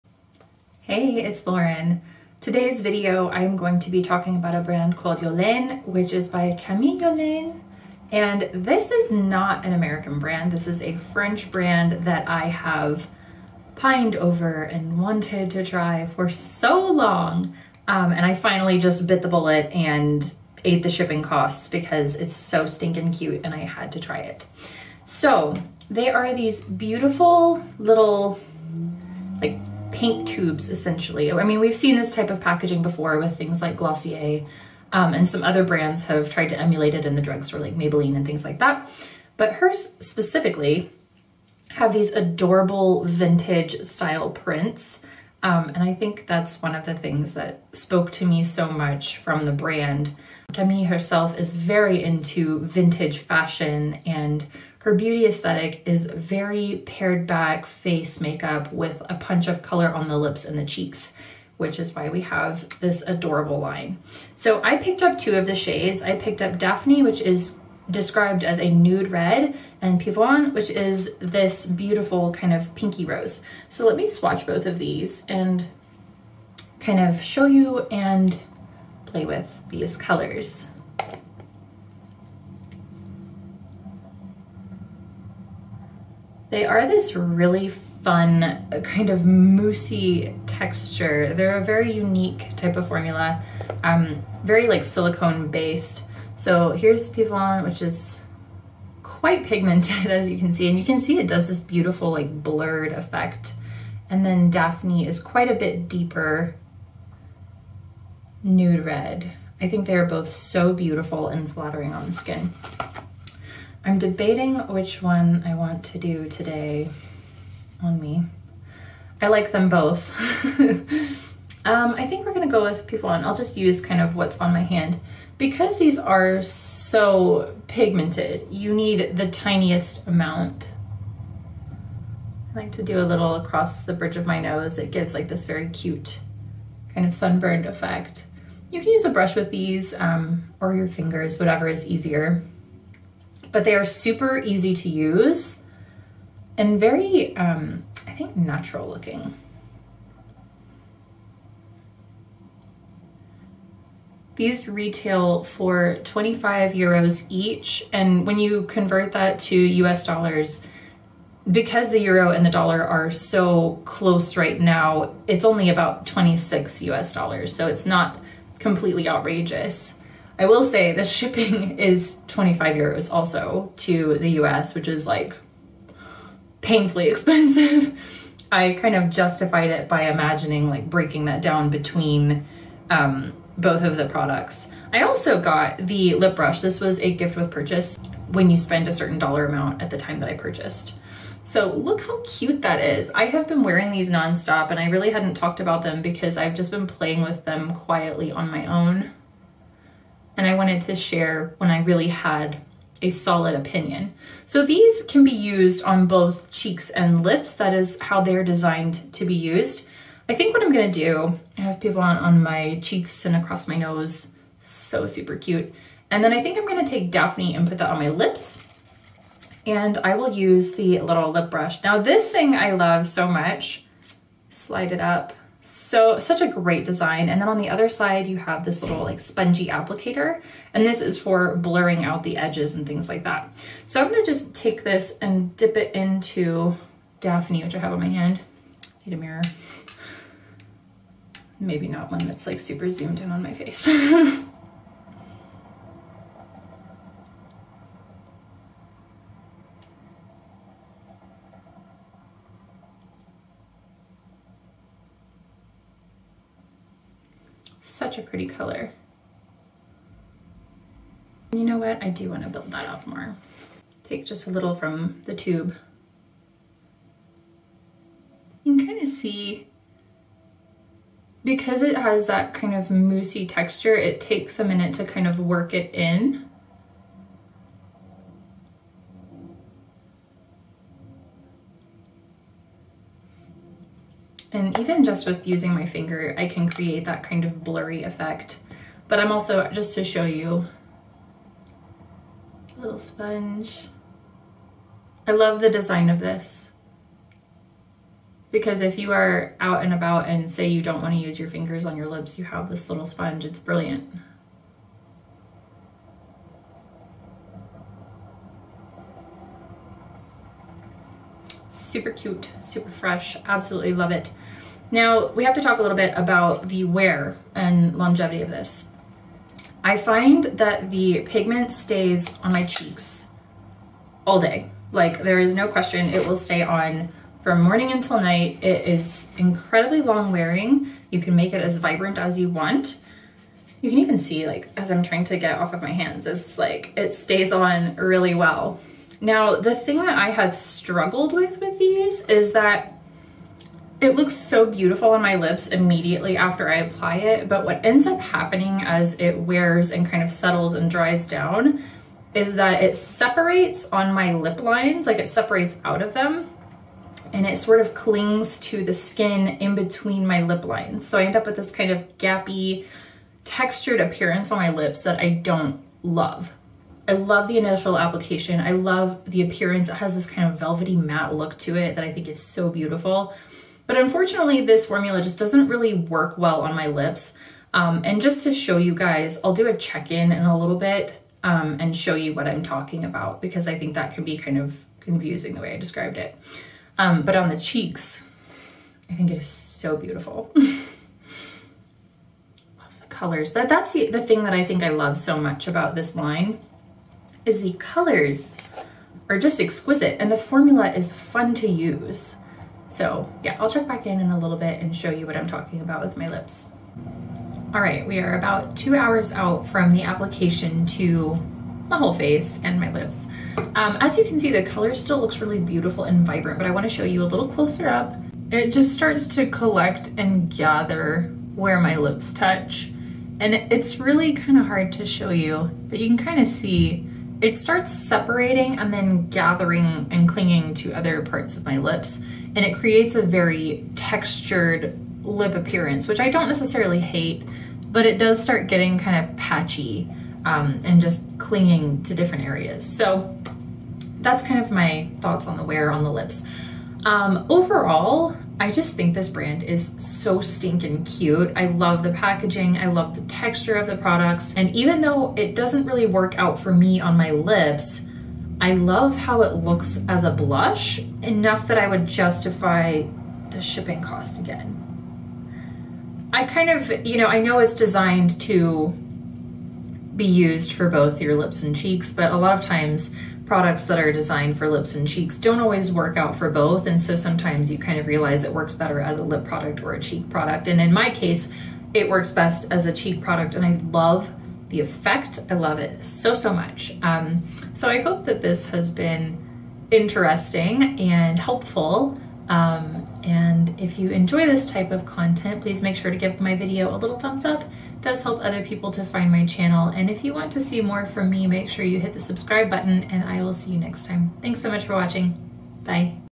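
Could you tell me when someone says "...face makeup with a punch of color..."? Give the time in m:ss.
0:57.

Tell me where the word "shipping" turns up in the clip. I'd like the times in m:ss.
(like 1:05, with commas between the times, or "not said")
0:20, 2:51, 7:43.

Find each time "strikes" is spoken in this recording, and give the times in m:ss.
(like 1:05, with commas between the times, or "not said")
not said.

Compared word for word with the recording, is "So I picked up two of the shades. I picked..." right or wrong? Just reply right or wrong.
right.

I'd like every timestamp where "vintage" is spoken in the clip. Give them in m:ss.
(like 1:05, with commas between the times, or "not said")
0:43, 0:52.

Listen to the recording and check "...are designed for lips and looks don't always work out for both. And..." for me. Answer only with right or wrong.
wrong.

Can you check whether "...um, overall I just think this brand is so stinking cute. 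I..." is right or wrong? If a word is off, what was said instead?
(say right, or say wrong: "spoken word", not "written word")
right.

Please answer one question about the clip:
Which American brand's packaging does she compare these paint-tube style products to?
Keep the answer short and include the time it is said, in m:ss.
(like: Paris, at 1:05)
Glossier, at 0:33.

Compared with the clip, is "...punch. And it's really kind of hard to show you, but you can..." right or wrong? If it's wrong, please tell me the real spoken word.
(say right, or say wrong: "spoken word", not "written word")
wrong: "touch", not "punch".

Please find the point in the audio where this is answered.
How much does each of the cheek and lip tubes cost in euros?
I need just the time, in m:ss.
2:36.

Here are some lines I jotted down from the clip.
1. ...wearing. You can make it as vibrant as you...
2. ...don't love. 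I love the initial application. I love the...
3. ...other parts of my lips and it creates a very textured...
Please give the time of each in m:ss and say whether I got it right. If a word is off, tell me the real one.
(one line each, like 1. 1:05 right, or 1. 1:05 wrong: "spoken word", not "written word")
1. 5:30 right
2. 6:05 right
3. 7:10 right.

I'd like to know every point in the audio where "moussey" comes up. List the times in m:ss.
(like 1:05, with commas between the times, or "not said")
1:29, 4:32.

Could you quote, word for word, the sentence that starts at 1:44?
And then Daphne is quite a bit deeper nude red.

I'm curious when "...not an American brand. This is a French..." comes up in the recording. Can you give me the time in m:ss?
0:09.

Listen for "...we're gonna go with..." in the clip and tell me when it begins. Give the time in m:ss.
2:02.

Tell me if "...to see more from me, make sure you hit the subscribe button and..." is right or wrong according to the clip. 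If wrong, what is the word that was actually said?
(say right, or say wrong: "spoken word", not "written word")
right.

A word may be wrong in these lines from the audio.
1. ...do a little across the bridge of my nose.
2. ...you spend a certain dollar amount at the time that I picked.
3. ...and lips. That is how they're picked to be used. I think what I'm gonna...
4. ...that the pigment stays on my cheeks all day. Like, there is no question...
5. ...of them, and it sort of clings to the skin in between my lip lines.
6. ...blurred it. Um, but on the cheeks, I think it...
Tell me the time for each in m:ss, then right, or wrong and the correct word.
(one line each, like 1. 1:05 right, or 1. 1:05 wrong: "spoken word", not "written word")
1. 2:12 right
2. 3:08 wrong: "purchased", not "picked"
3. 3:26 wrong: "designed", not "picked"
4. 5:20 right
5. 5:56 right
6. 6:25 wrong: "described", not "blurred".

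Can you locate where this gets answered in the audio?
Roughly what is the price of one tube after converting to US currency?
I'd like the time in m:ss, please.
2:45.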